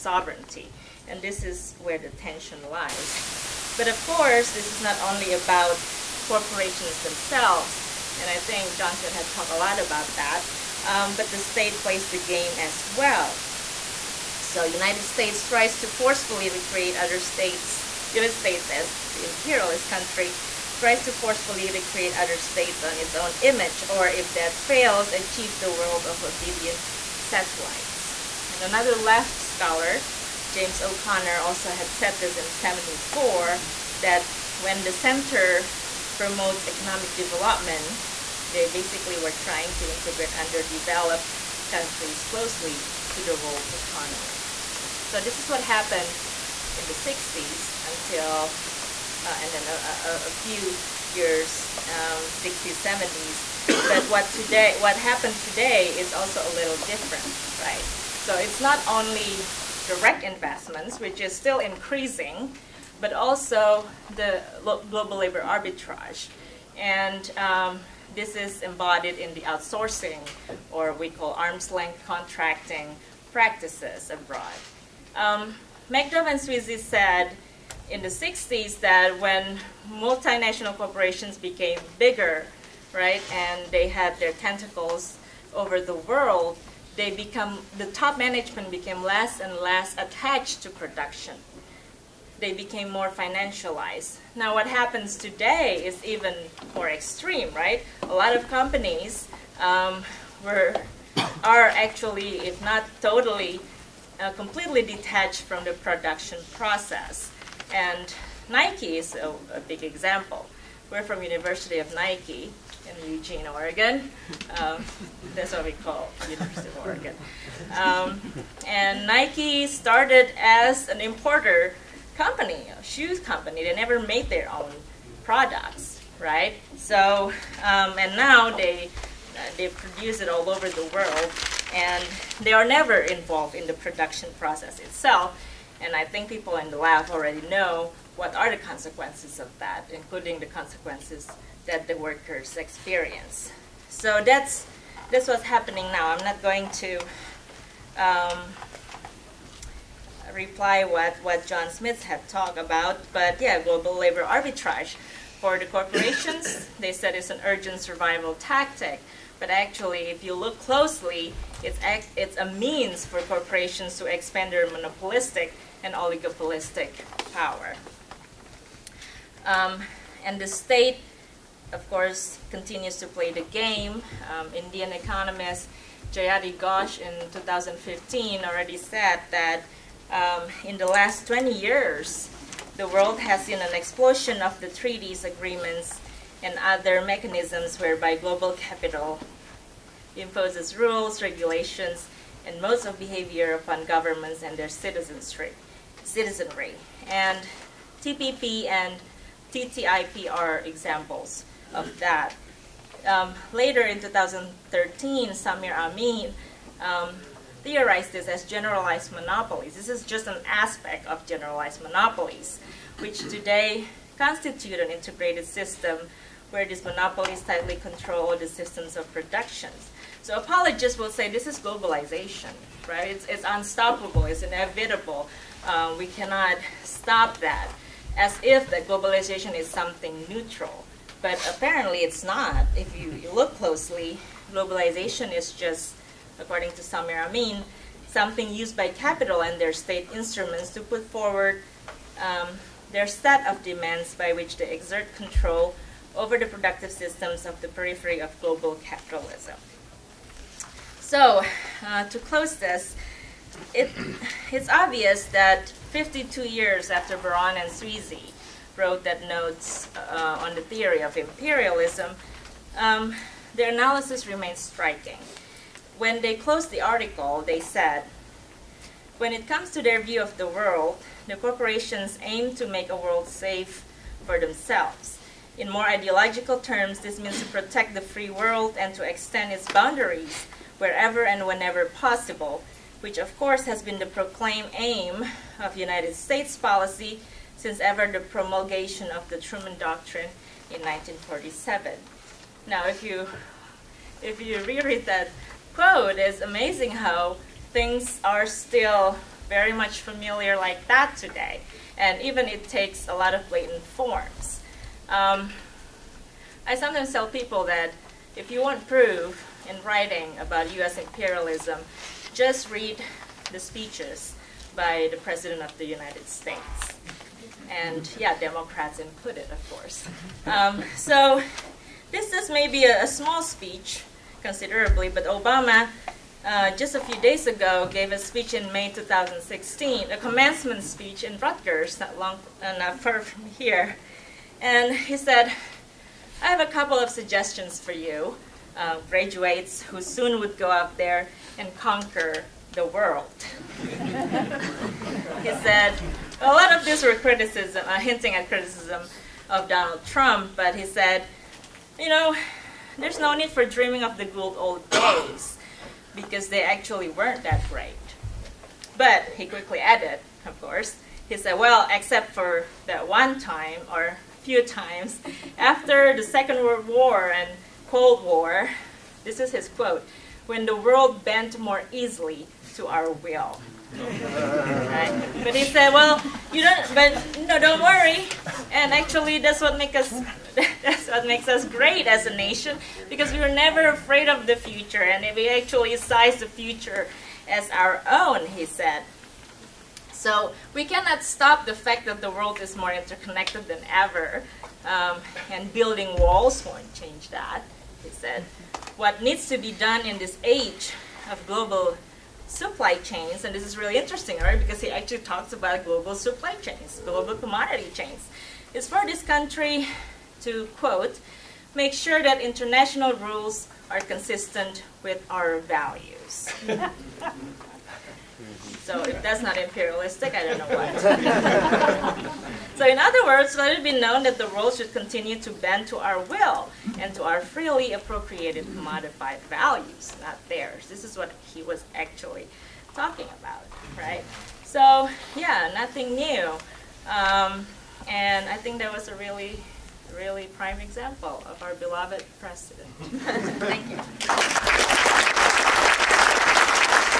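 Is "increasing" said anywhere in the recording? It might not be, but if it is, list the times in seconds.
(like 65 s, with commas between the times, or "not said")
61 s.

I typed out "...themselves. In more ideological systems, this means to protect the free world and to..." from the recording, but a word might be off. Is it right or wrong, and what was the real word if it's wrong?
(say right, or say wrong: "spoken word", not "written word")
wrong: "terms", not "systems".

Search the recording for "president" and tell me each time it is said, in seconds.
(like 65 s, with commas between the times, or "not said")
315 s, 442 s.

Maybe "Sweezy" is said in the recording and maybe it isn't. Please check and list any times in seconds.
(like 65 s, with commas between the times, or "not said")
76 s, 257 s.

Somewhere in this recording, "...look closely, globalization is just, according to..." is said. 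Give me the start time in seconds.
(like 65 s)
233 s.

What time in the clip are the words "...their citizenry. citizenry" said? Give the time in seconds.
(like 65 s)
194 s.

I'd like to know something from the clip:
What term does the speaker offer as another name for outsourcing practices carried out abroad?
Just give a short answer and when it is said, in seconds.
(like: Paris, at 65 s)
arm's length contracting, at 71 s.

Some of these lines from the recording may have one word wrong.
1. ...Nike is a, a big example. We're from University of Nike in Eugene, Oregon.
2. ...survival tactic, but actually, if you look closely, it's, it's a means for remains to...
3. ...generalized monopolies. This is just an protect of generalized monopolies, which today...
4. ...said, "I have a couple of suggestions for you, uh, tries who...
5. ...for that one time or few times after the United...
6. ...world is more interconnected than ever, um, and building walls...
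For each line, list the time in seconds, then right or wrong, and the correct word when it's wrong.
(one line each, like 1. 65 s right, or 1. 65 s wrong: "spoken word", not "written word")
1. 108 s right
2. 157 s wrong: "corporations", not "remains"
3. 208 s wrong: "aspect", not "protect"
4. 335 s wrong: "graduates", not "tries"
5. 362 s wrong: "Second", not "United"
6. 392 s right.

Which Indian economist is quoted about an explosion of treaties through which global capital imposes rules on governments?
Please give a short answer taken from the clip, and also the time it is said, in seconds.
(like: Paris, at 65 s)
Jayati Ghosh, at 176 s.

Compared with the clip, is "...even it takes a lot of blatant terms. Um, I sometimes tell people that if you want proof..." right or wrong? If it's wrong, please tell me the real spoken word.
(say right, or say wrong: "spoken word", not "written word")
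wrong: "forms", not "terms".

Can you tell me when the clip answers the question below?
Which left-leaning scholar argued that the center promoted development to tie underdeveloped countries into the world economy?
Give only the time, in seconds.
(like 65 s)
30 s.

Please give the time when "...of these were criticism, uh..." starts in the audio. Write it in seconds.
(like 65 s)
346 s.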